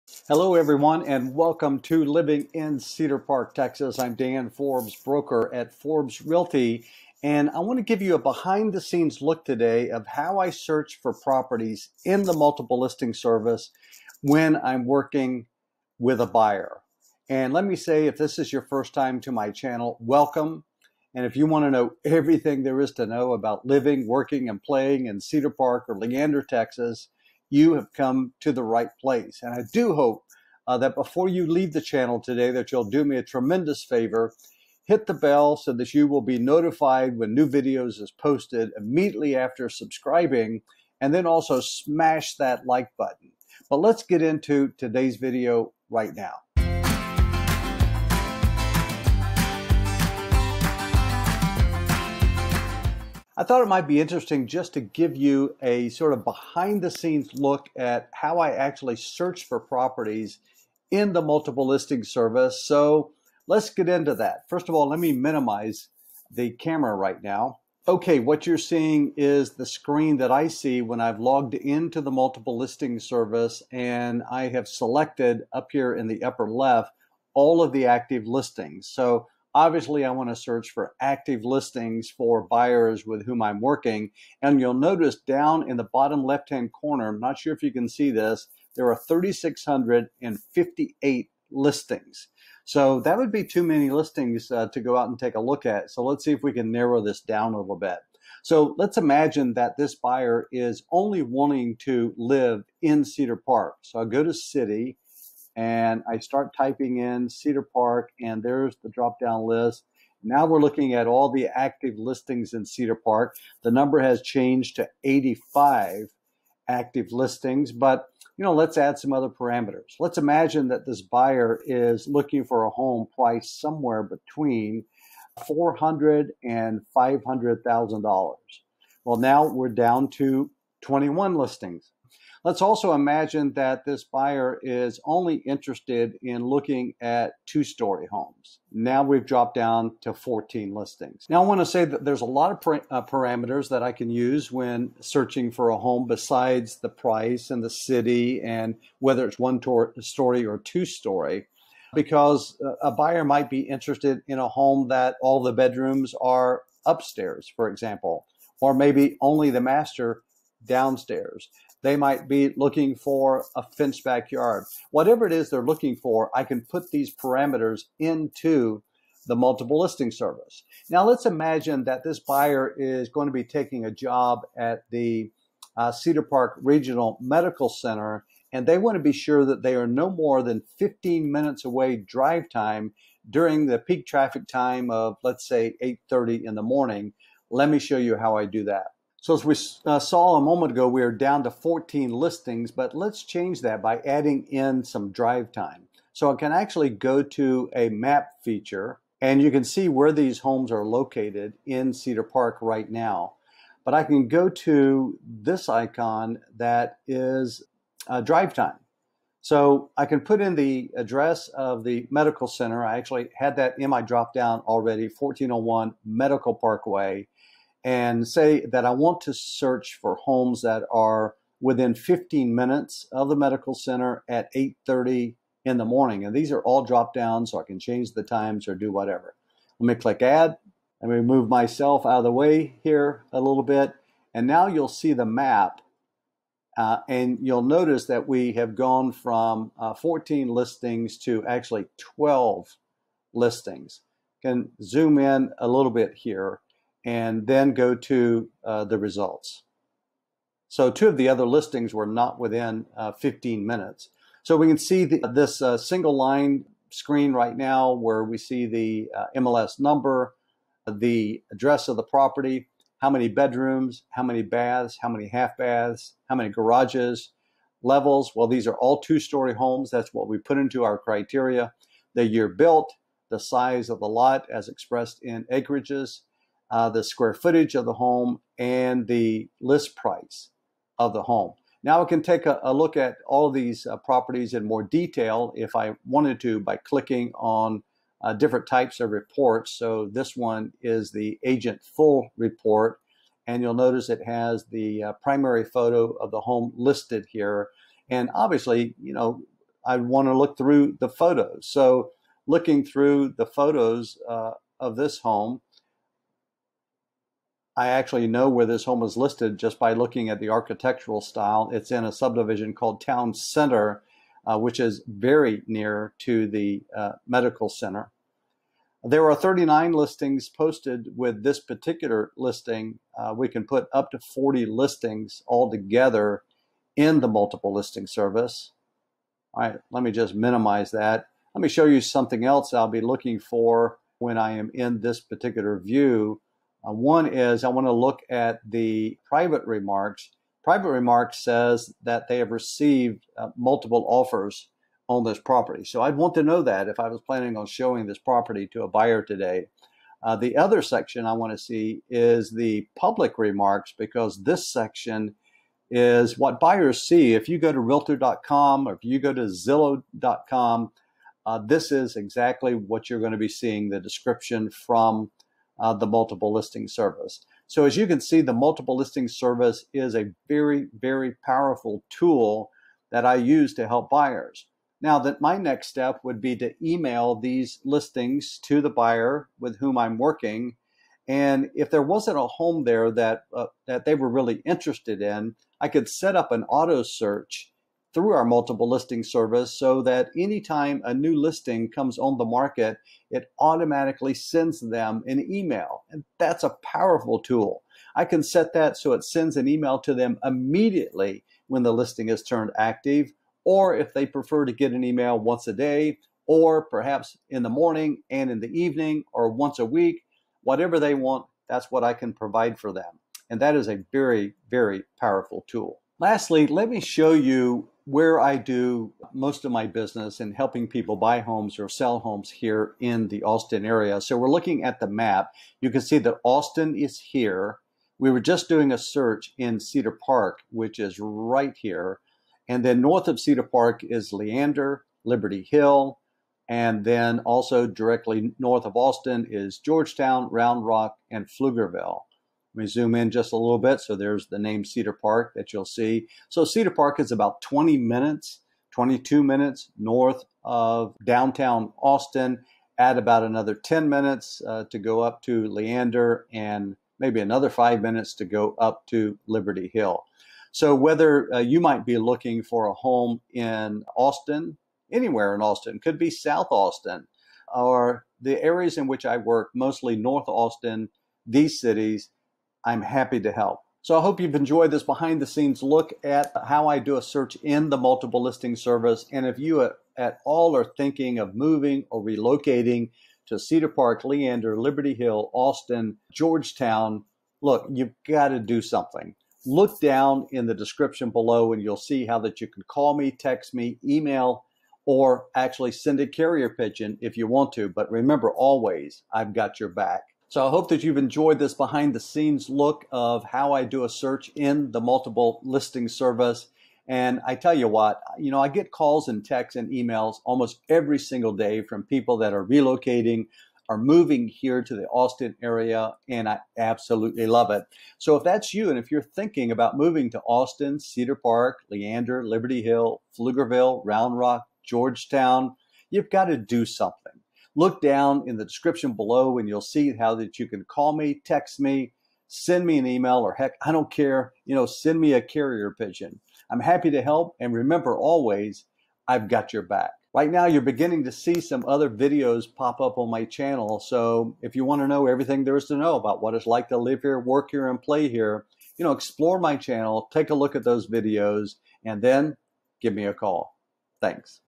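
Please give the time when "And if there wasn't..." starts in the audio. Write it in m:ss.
6:21.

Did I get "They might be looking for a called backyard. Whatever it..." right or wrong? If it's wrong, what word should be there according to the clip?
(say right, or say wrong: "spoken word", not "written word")
wrong: "fenced", not "called".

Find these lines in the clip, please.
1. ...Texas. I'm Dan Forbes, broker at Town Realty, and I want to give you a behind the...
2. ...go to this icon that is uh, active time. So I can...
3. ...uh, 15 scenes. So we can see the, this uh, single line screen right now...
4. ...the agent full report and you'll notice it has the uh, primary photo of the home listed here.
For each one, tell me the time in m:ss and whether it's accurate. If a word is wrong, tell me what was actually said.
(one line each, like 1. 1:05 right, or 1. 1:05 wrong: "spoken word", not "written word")
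1. 0:03 wrong: "Forbes", not "Town"
2. 3:24 wrong: "drive", not "active"
3. 4:12 wrong: "minutes", not "scenes"
4. 4:51 right.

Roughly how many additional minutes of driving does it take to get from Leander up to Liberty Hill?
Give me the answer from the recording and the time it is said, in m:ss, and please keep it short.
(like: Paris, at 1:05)
5, at 7:37.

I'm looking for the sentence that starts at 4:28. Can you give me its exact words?
Well, these are all two story homes.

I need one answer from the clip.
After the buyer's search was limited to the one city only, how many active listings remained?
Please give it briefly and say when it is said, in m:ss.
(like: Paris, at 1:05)
85, at 1:55.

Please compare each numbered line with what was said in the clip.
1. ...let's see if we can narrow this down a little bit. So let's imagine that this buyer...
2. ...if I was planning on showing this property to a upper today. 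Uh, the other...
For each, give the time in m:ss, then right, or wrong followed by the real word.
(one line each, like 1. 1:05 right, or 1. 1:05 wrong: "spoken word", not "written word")
1. 1:36 right
2. 5:46 wrong: "buyer", not "upper".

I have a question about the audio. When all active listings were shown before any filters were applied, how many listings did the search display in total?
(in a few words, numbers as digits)
3,658.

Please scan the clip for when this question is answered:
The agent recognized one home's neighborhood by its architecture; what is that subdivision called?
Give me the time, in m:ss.
5:12.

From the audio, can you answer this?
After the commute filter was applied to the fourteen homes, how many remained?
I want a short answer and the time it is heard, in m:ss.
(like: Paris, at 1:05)
12, at 4:02.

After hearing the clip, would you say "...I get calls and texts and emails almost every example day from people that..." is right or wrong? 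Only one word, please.
wrong.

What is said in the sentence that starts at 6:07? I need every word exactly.
So as you can see, the multiple listing service is a very, very powerful tool that I use to help buyers.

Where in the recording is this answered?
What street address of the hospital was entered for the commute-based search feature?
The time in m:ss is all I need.
3:35.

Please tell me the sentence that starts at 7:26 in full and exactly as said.
So Cedar Park is about 20 minutes, 22 minutes north of downtown Austin.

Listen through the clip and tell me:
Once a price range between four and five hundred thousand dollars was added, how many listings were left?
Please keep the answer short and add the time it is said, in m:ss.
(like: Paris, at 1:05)
21, at 2:10.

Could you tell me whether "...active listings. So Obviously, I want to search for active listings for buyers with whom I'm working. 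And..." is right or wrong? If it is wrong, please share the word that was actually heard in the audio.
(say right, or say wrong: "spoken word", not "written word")
right.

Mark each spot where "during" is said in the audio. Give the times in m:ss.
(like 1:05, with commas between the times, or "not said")
3:03.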